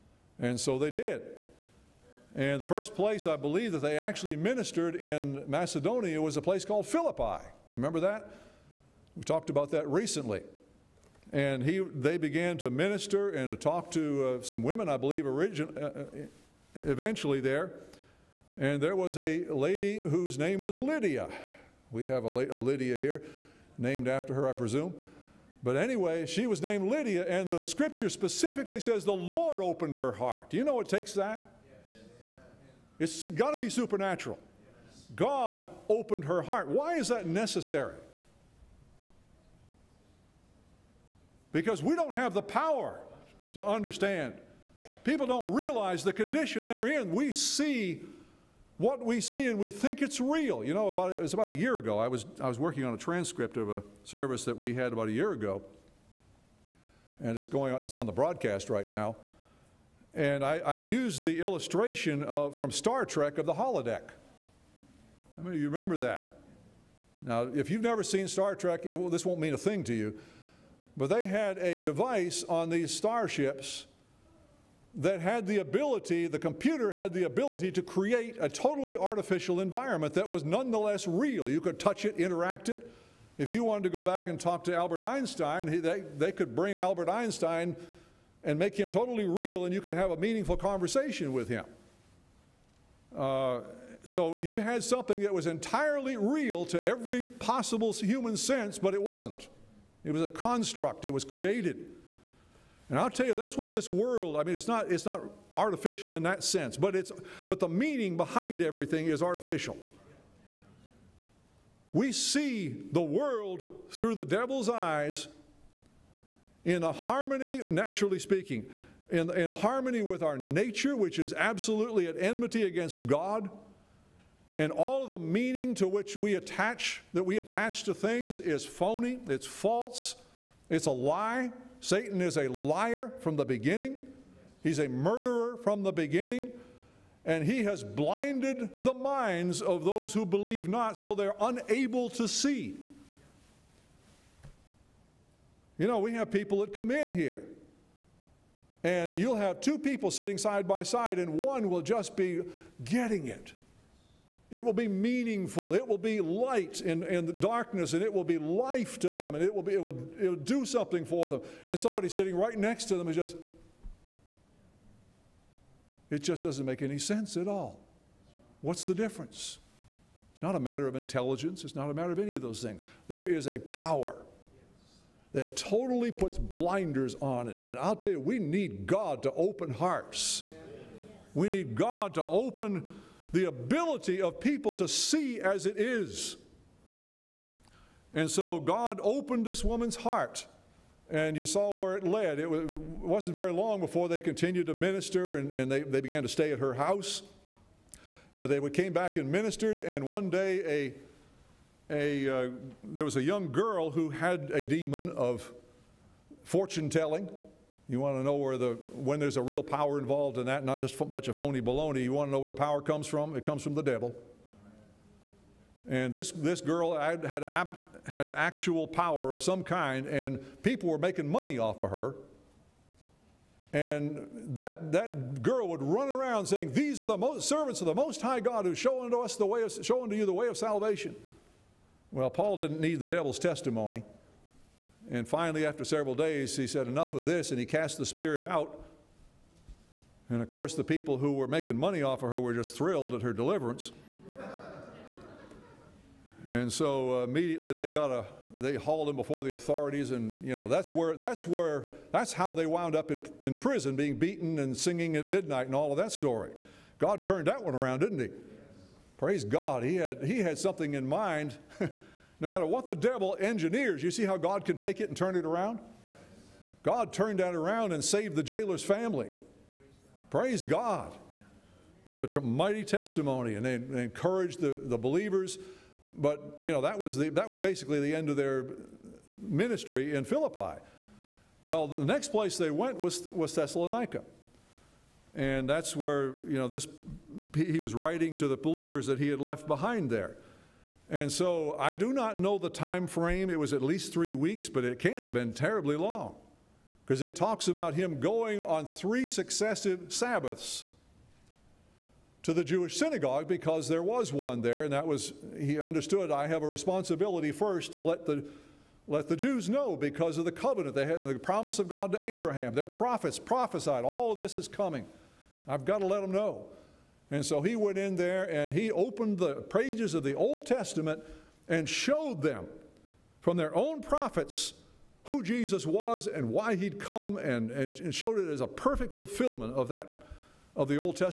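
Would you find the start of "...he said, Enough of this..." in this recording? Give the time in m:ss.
3:56.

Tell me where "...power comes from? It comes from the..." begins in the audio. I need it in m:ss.
3:32.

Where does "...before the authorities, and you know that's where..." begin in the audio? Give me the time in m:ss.
4:09.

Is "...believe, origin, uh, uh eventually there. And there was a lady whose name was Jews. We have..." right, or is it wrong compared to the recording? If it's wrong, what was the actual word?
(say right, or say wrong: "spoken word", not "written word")
wrong: "Lydia", not "Jews".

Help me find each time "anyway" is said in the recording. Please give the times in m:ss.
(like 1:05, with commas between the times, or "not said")
0:25.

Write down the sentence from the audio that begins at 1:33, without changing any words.
Uh, so you had something that was entirely real to every possible human sense, but it wasn't.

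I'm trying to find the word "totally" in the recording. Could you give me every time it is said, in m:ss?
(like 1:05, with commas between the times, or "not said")
1:18, 1:28, 2:55.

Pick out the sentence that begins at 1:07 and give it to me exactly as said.
Now, if you've never seen Star Trek, it, well, this won't mean a thing to you.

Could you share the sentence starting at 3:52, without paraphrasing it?
Well, Paul didn't need the devil's testimony.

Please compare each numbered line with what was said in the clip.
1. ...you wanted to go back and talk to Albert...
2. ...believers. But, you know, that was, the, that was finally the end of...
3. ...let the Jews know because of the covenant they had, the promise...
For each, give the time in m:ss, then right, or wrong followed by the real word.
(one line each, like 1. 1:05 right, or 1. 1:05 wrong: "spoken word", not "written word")
1. 1:23 right
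2. 4:34 wrong: "basically", not "finally"
3. 5:09 right.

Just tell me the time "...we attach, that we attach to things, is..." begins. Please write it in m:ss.
2:06.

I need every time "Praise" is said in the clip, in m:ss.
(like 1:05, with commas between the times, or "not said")
4:19, 4:30.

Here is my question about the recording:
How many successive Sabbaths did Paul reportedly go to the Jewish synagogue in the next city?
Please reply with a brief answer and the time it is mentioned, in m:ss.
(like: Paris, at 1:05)
3, at 4:58.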